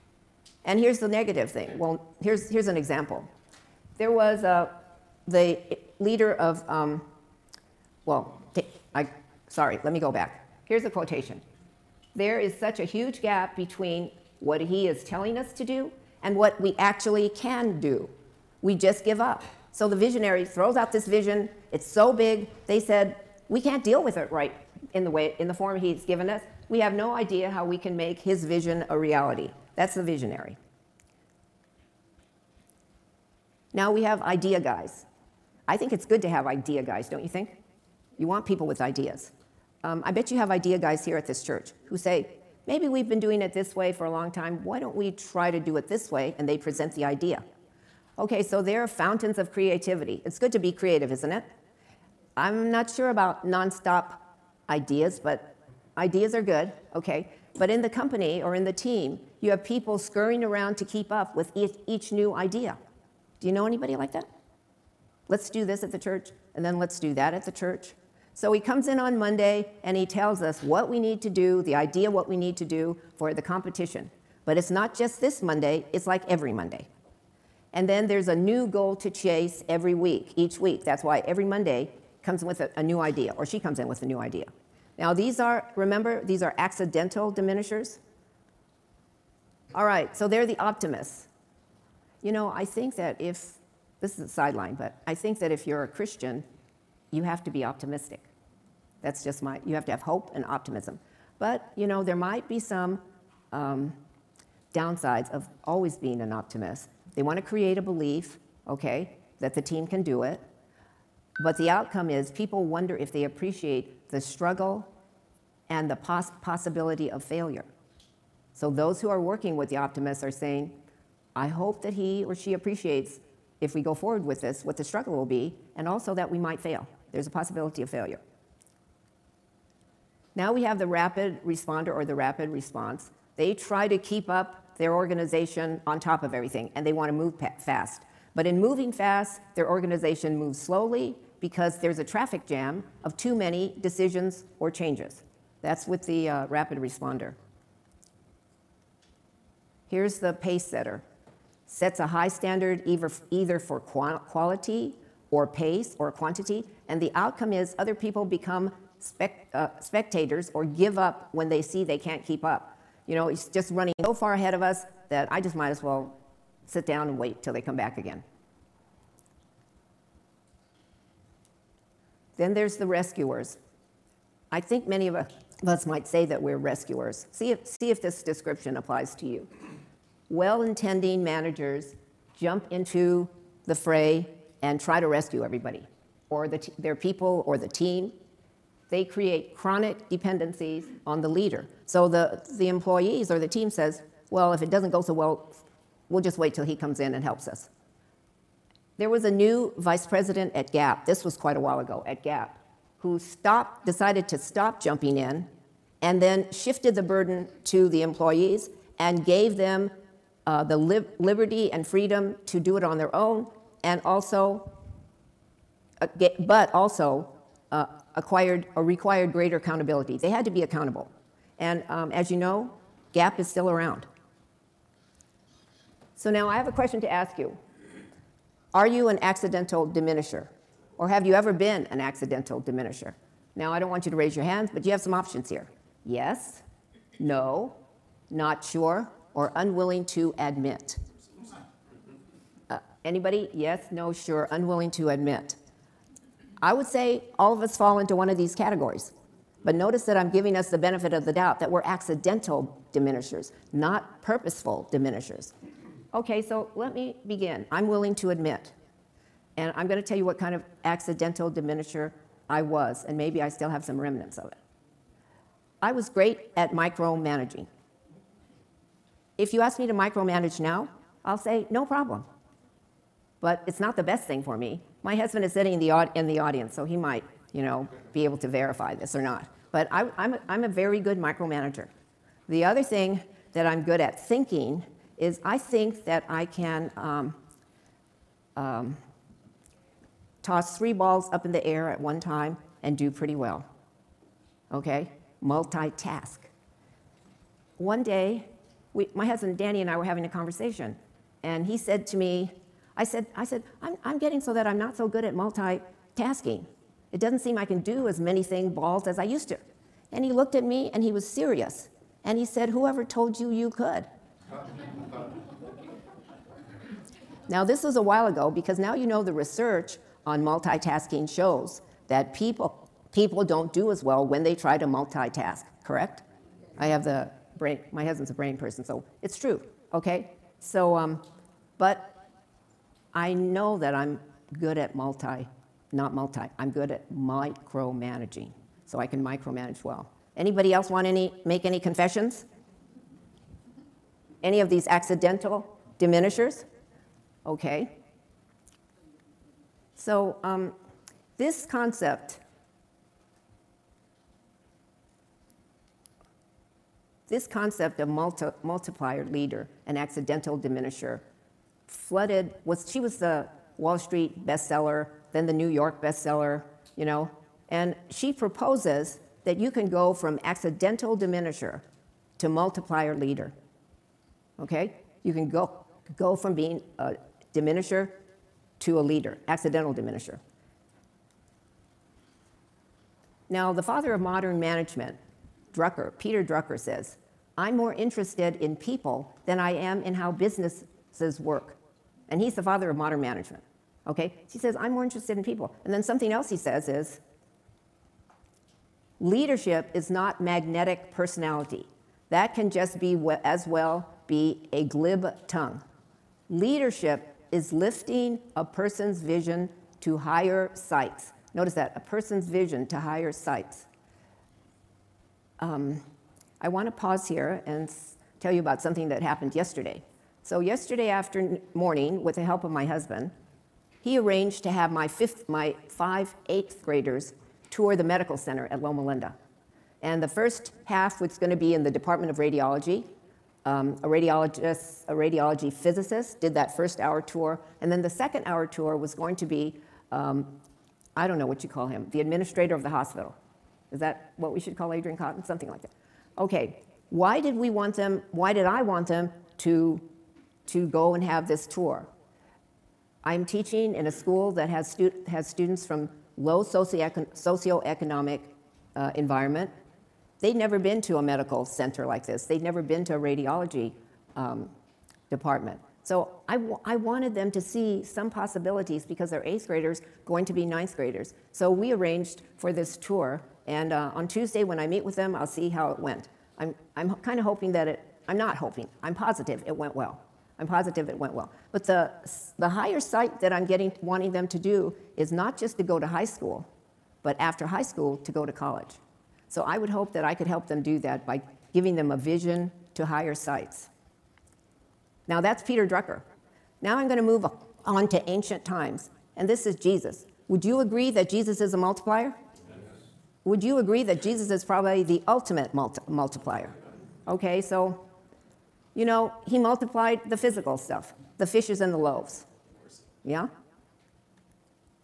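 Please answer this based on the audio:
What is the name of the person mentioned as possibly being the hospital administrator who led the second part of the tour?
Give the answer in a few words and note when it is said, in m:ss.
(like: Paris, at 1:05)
Adrian Cotton, at 7:24.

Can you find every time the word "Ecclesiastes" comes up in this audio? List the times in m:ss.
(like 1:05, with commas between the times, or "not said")
not said.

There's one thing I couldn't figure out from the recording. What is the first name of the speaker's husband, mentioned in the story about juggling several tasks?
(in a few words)
Danny.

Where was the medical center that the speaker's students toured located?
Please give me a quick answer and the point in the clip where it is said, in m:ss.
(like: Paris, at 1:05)
Loma Linda, at 7:08.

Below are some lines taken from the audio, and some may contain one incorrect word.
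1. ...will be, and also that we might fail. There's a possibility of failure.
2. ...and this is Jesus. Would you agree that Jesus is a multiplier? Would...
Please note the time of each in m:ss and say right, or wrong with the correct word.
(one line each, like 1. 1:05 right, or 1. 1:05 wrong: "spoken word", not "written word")
1. 2:05 right
2. 8:19 right.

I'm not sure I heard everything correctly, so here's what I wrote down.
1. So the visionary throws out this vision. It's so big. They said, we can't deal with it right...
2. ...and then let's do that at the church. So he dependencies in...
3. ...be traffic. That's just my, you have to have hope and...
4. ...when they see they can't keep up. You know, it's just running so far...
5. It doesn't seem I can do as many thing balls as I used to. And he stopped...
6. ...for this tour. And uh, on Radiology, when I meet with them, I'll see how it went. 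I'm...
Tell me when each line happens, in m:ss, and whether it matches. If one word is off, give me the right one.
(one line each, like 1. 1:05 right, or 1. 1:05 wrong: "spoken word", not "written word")
1. 0:19 right
2. 1:06 wrong: "comes", not "dependencies"
3. 1:37 wrong: "optimistic", not "traffic"
4. 2:41 right
5. 5:07 wrong: "looked", not "stopped"
6. 7:52 wrong: "Tuesday", not "Radiology".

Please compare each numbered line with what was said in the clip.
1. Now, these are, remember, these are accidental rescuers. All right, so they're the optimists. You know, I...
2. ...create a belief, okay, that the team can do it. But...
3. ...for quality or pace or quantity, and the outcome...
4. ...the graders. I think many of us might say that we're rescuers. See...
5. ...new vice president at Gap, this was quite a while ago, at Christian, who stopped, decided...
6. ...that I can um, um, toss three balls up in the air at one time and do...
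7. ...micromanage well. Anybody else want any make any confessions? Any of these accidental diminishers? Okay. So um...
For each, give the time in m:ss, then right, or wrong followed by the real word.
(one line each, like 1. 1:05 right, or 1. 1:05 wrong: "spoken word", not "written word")
1. 1:24 wrong: "diminishers", not "rescuers"
2. 1:47 right
3. 2:33 right
4. 2:52 wrong: "rescuers", not "graders"
5. 3:19 wrong: "Gap", not "Christian"
6. 4:46 right
7. 5:39 right.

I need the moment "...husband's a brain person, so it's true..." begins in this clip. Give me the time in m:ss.
5:28.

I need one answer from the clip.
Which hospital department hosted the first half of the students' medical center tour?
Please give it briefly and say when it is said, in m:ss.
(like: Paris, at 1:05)
Department of Radiology, at 7:11.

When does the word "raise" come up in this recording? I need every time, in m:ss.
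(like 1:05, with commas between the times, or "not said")
3:54.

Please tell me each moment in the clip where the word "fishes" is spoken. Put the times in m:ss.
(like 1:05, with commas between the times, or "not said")
8:31.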